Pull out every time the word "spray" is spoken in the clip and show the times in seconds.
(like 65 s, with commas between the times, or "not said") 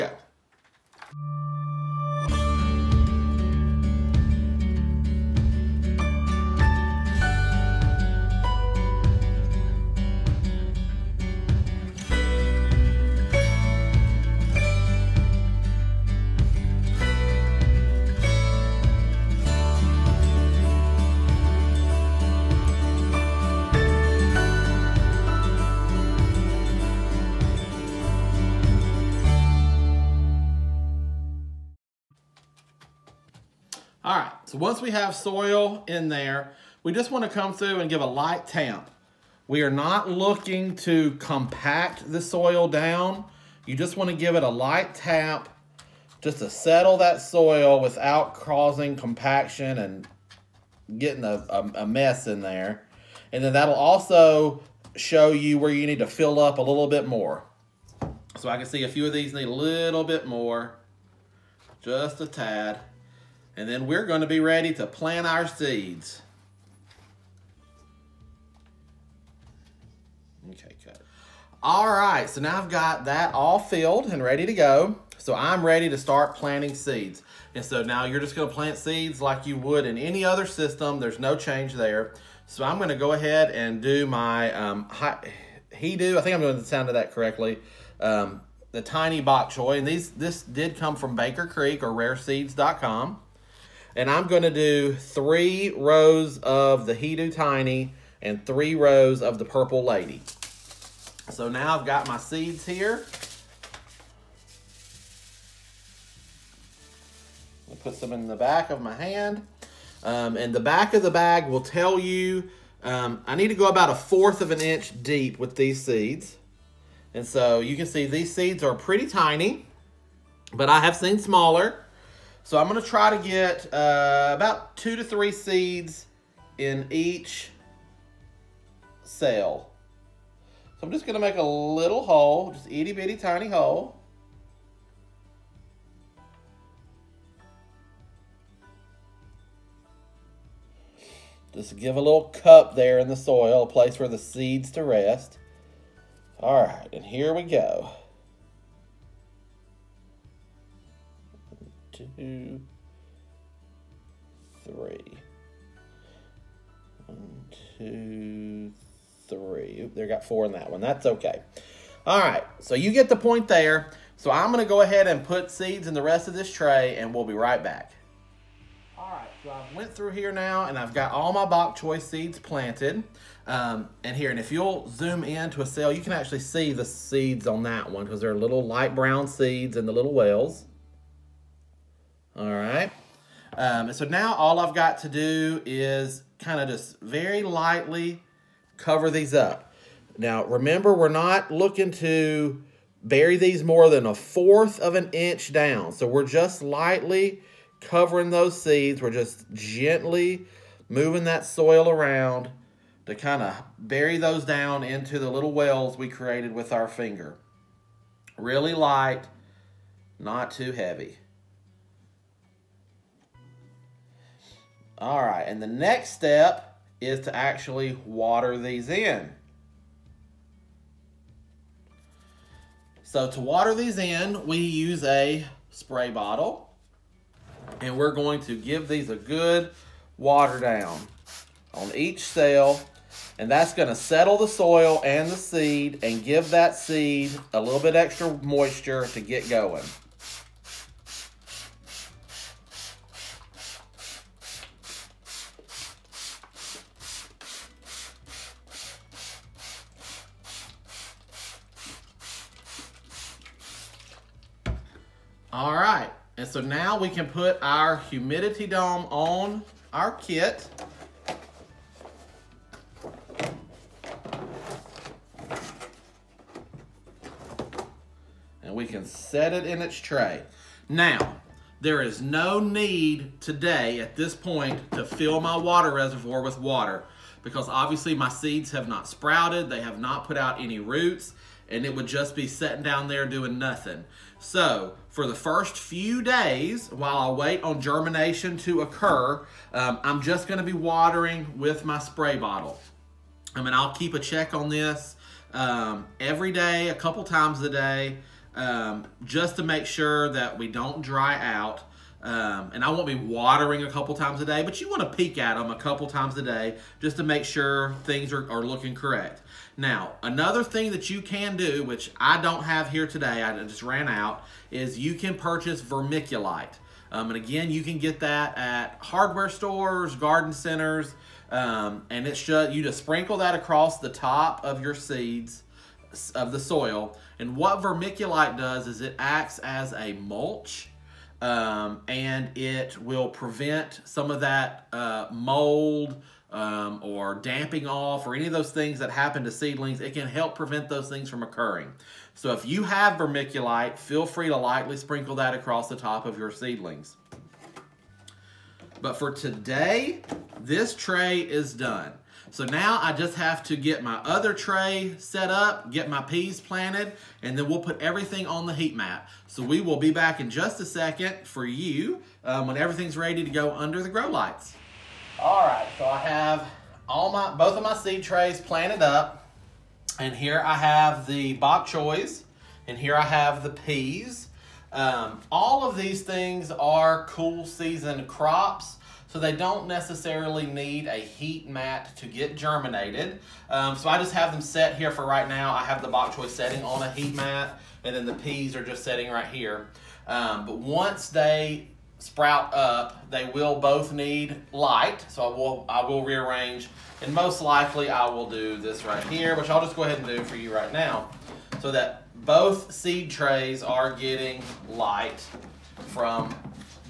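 225 s, 291 s.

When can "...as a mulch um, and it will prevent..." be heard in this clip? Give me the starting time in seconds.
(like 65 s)
329 s.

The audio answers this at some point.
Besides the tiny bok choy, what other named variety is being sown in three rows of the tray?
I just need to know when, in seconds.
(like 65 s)
99 s.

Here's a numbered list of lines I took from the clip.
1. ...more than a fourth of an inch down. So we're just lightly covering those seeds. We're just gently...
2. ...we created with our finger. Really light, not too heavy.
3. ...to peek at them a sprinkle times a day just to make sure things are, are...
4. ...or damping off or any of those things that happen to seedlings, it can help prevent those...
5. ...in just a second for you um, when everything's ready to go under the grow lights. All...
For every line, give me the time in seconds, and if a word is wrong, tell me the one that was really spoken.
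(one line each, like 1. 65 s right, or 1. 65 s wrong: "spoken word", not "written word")
1. 193 s right
2. 205 s right
3. 305 s wrong: "couple", not "sprinkle"
4. 337 s right
5. 360 s right.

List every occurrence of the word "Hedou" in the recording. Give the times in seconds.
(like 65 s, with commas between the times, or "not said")
84 s, 96 s.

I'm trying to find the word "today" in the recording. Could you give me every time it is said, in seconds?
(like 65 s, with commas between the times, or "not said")
273 s, 313 s, 349 s.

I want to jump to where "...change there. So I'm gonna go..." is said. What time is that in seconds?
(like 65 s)
81 s.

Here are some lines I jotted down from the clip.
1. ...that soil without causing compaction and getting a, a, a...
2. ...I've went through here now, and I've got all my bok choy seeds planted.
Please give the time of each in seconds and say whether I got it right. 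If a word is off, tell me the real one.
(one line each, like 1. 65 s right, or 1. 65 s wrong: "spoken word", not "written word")
1. 46 s right
2. 169 s right.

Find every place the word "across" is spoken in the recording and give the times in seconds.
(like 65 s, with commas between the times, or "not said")
323 s, 345 s.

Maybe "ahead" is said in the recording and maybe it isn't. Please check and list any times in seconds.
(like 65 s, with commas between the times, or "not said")
83 s, 164 s, 400 s.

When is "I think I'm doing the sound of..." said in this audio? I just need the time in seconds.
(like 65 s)
86 s.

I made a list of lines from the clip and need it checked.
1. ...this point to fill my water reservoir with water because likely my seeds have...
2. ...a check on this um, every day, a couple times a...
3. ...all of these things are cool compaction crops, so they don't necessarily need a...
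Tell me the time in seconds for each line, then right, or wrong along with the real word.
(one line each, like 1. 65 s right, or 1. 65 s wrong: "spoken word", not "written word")
1. 274 s wrong: "obviously", not "likely"
2. 294 s right
3. 375 s wrong: "season", not "compaction".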